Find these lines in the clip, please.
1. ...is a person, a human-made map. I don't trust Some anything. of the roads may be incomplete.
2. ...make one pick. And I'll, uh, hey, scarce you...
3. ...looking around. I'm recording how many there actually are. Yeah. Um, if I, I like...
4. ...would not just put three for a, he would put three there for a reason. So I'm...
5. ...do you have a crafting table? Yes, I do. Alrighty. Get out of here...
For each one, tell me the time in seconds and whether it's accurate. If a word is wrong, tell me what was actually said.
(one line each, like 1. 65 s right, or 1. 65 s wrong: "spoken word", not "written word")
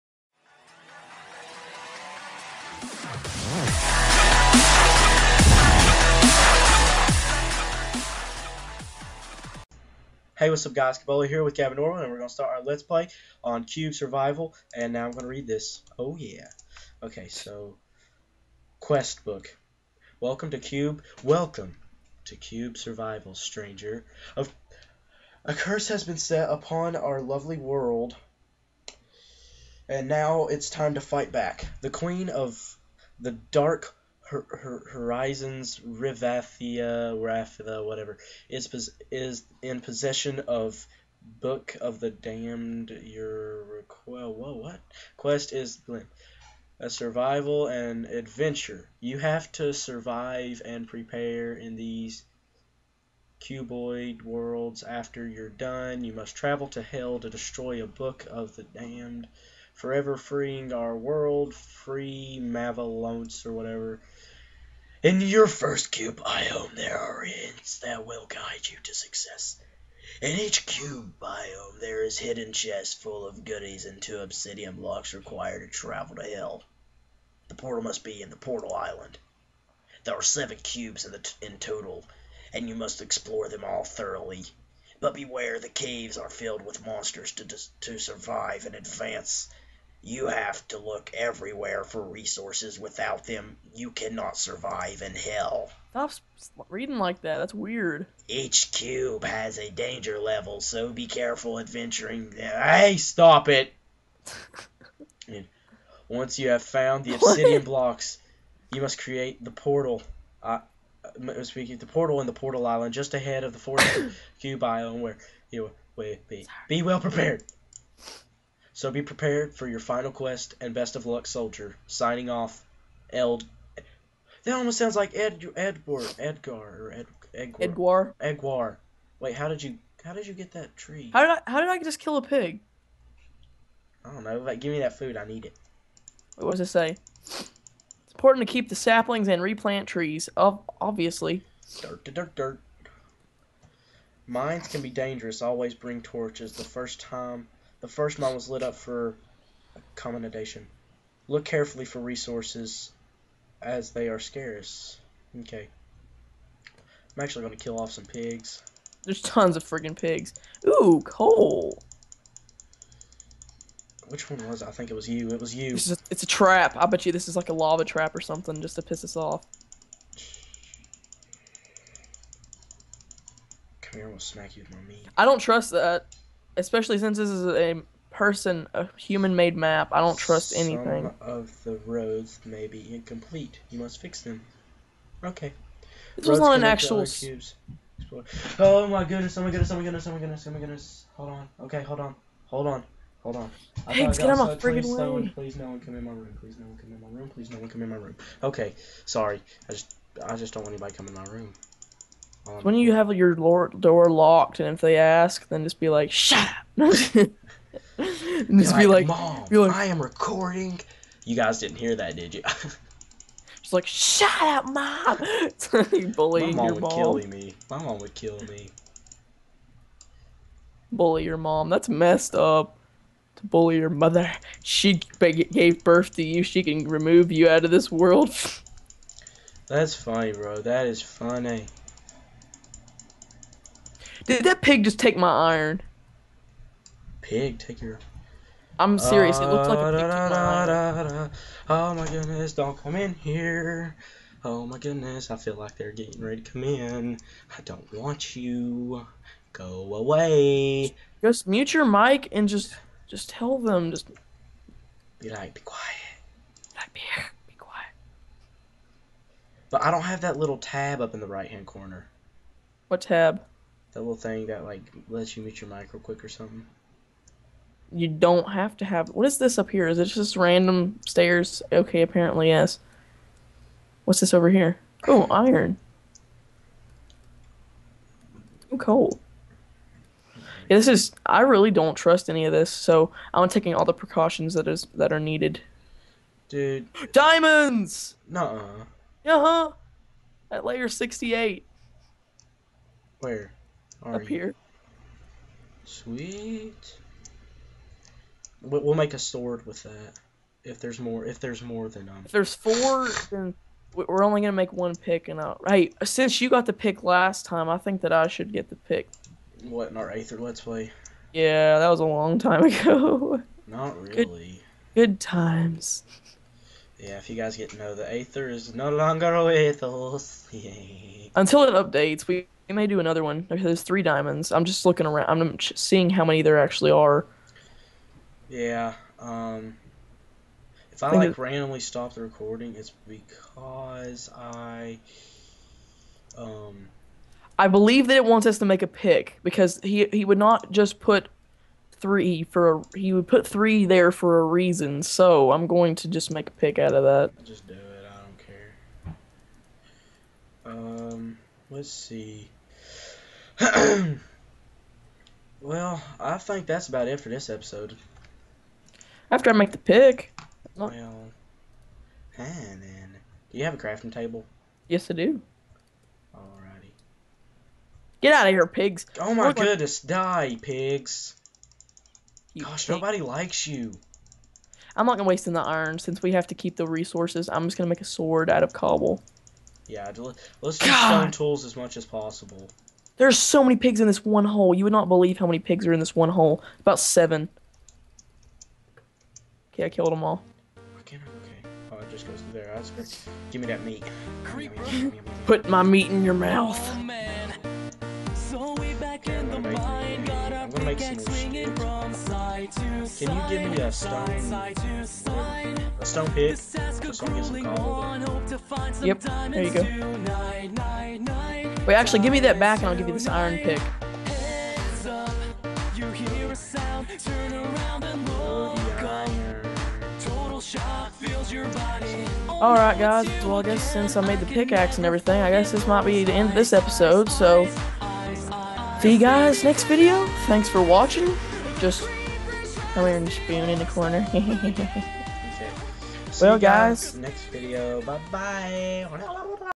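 1. 177 s right
2. 304 s wrong: "since", not "scarce"
3. 324 s wrong: "seeing", not "recording"
4. 340 s right
5. 363 s right.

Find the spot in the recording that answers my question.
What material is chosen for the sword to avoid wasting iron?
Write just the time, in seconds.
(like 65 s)
378 s.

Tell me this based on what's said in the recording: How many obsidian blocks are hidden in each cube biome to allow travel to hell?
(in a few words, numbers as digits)
2.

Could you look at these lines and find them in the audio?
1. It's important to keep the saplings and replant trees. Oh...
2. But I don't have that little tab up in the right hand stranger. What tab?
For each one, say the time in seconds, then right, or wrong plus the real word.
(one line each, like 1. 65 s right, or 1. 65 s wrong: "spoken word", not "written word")
1. 137 s right
2. 259 s wrong: "corner", not "stranger".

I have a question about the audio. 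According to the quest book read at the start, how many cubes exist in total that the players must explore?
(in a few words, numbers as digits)
7.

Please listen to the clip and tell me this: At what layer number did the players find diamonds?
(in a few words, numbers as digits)
68.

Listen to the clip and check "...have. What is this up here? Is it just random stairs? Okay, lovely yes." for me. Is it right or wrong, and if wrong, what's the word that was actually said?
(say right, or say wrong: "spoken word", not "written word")
wrong: "apparently", not "lovely".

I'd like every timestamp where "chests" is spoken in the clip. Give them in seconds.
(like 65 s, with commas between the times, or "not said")
72 s.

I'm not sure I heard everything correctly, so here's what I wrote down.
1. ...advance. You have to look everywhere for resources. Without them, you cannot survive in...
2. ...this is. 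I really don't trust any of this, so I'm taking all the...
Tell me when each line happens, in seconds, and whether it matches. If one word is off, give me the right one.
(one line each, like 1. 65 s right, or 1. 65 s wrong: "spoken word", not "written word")
1. 88 s right
2. 280 s right.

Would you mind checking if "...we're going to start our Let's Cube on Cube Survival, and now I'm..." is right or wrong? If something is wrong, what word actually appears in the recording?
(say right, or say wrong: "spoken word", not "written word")
wrong: "Play", not "Cube".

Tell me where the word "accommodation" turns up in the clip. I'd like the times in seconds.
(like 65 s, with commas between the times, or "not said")
149 s.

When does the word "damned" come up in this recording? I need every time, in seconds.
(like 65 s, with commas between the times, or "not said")
42 s, 58 s.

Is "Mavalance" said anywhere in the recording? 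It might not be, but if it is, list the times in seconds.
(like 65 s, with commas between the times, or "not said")
62 s.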